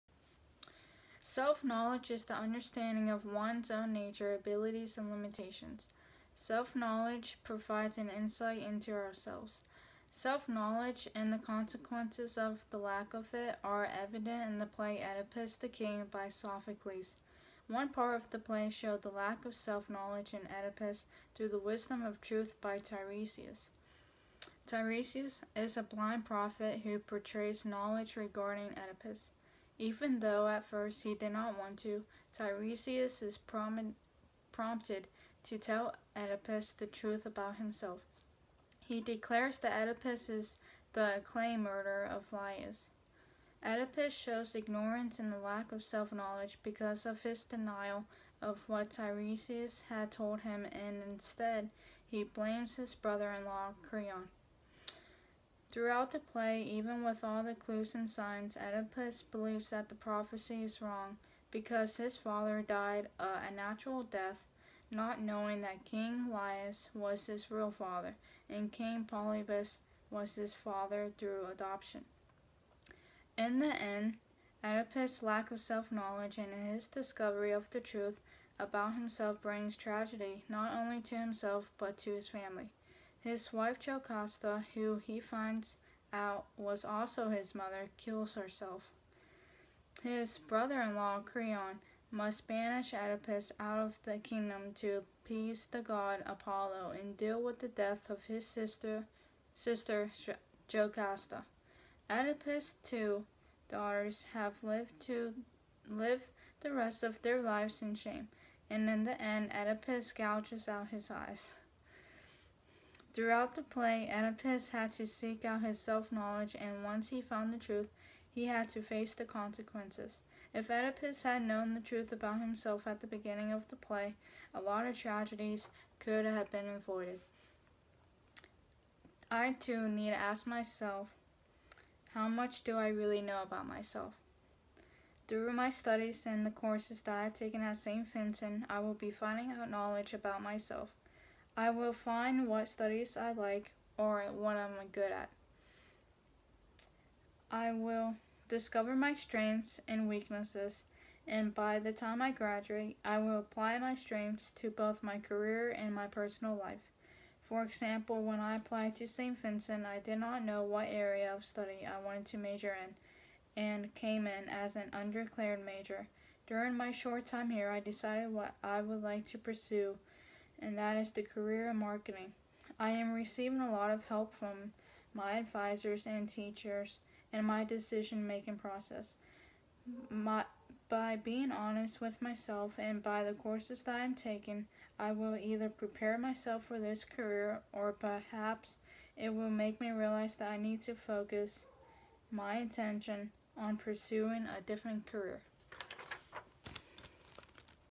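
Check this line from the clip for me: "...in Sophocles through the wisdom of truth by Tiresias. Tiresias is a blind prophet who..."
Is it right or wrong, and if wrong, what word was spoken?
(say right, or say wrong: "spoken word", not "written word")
wrong: "Oedipus", not "Sophocles".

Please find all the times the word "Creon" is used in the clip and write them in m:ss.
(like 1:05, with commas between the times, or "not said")
0:53, 1:31.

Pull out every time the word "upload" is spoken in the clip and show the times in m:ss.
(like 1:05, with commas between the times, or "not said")
not said.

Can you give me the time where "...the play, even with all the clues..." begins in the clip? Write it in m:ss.
0:56.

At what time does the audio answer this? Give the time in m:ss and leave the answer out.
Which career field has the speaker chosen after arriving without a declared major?
2:51.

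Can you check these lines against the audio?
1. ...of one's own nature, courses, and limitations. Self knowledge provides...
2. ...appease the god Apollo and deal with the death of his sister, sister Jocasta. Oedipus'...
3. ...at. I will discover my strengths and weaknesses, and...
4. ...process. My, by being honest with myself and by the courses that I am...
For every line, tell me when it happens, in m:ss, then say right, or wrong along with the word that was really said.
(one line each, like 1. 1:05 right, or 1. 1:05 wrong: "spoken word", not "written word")
1. 0:03 wrong: "abilities", not "courses"
2. 1:35 right
3. 2:25 right
4. 2:58 right.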